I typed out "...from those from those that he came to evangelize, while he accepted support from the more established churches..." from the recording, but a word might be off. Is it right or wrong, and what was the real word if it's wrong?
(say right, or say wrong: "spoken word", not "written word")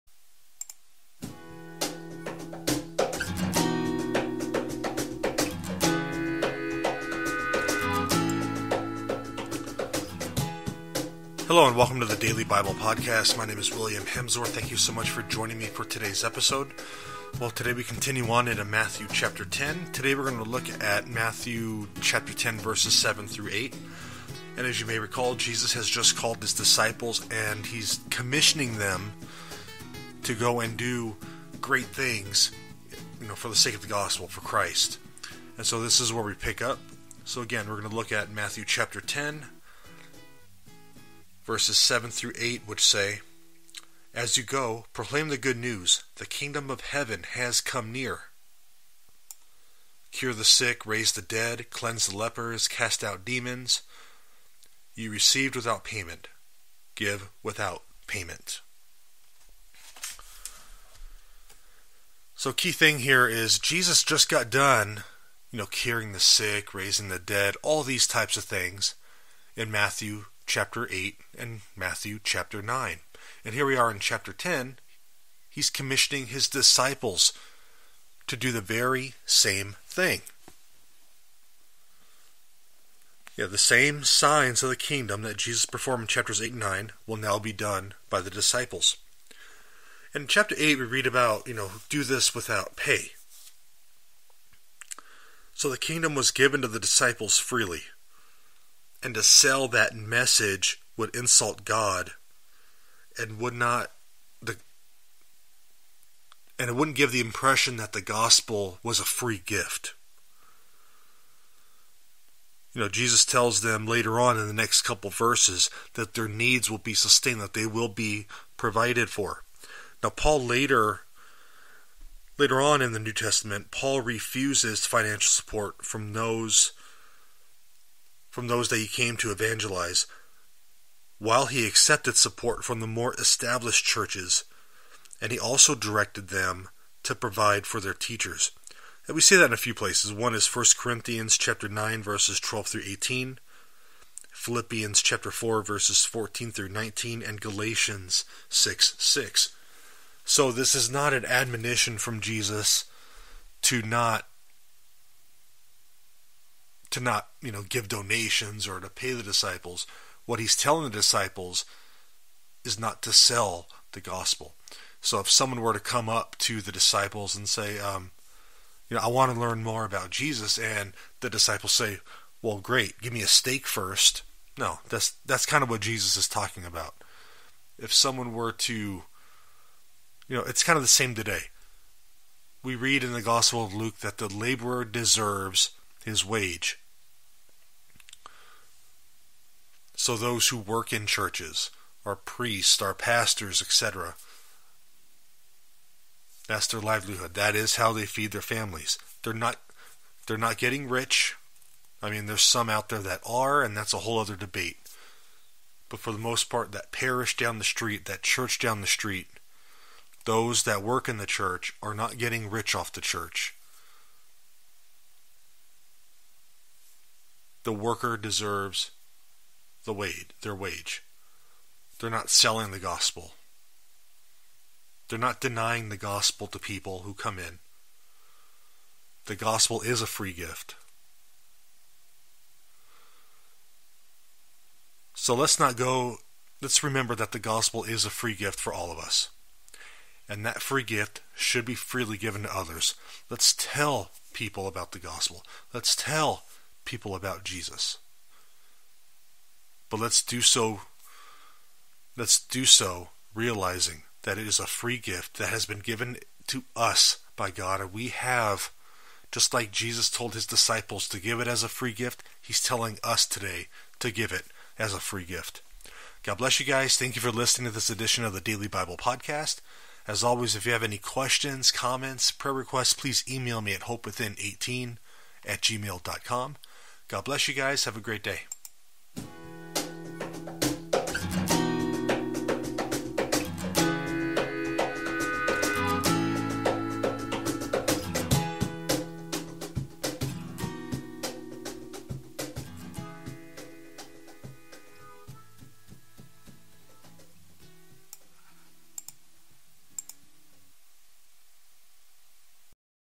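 right.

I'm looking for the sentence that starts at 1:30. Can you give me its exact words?
In chapter 8, we read about, you know, do this without pay.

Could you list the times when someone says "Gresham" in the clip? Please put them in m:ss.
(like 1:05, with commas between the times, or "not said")
not said.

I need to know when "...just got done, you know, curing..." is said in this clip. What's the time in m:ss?
1:04.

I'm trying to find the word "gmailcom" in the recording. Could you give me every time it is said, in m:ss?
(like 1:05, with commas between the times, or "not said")
4:35.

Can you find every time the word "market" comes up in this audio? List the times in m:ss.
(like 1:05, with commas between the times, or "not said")
not said.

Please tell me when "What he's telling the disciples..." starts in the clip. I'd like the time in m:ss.
2:40.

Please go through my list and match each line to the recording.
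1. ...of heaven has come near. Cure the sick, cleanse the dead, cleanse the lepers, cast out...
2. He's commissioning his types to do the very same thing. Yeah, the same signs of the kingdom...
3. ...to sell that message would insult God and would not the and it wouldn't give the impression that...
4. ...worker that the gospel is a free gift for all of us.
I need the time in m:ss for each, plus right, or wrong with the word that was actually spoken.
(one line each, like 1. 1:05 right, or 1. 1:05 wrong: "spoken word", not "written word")
1. 0:46 wrong: "raise", not "cleanse"
2. 1:15 wrong: "disciples", not "types"
3. 1:39 right
4. 3:56 wrong: "remember", not "worker".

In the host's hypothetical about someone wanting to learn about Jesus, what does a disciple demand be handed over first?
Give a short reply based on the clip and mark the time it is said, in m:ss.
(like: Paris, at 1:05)
A steak, at 2:53.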